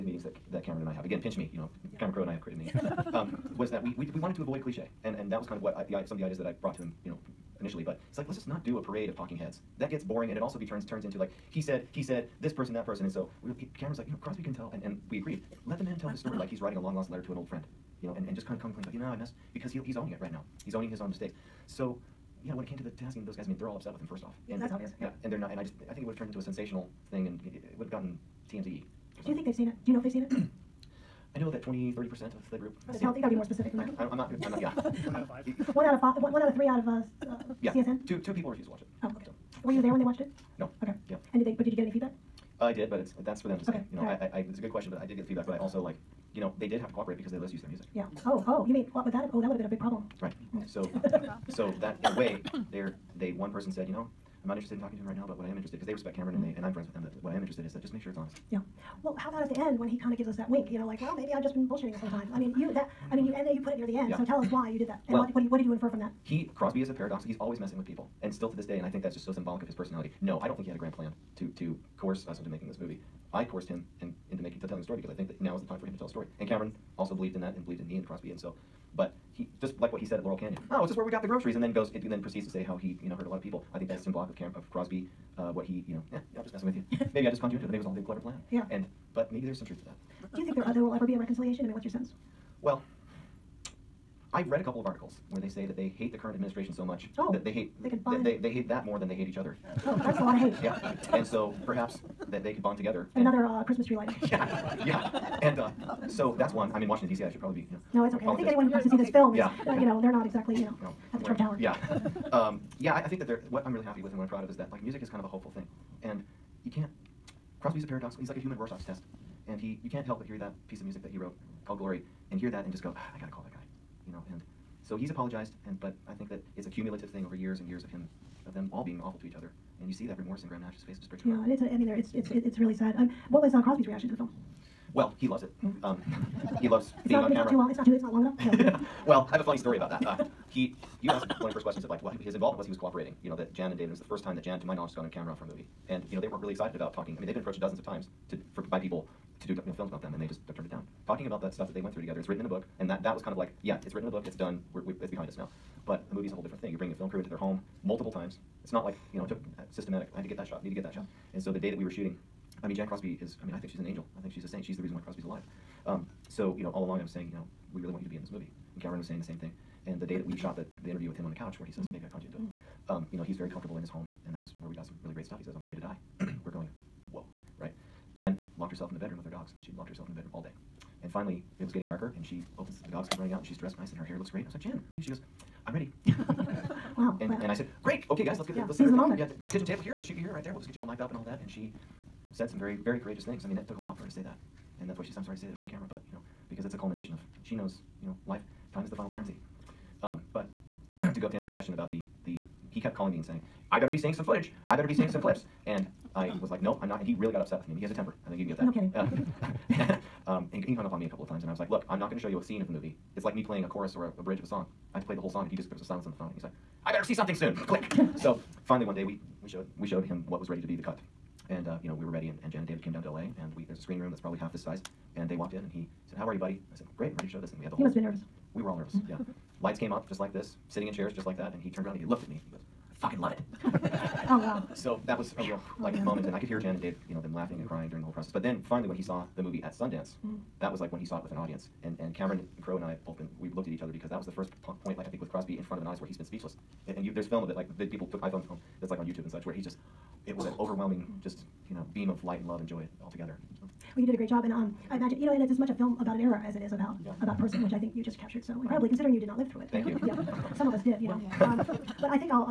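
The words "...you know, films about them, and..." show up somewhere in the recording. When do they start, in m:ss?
2:29.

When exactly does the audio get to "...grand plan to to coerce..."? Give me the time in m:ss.
1:10.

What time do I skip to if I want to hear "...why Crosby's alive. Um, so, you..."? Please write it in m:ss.
2:44.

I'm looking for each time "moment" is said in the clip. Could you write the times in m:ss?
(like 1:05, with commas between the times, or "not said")
3:08, 3:56.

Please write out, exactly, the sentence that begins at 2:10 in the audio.
It just breaks your yeah, heart.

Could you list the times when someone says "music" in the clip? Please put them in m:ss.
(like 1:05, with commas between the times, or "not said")
0:47, 1:54, 2:00.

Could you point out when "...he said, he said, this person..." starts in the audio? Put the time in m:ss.
0:11.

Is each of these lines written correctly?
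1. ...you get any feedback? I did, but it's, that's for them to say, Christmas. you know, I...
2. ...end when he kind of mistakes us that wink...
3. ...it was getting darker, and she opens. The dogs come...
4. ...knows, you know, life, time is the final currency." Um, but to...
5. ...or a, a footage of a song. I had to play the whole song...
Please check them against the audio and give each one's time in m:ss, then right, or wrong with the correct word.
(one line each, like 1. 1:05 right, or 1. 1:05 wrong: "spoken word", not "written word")
1. 0:41 wrong: "Okay", not "Christmas"
2. 0:59 wrong: "gives", not "mistakes"
3. 3:01 right
4. 3:17 right
5. 3:33 wrong: "bridge", not "footage".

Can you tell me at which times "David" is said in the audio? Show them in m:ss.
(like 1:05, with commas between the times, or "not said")
2:23, 3:42.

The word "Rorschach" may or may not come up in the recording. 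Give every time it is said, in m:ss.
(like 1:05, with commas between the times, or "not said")
1:58.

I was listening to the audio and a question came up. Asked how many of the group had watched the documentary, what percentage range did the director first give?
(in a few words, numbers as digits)
20 to 30%.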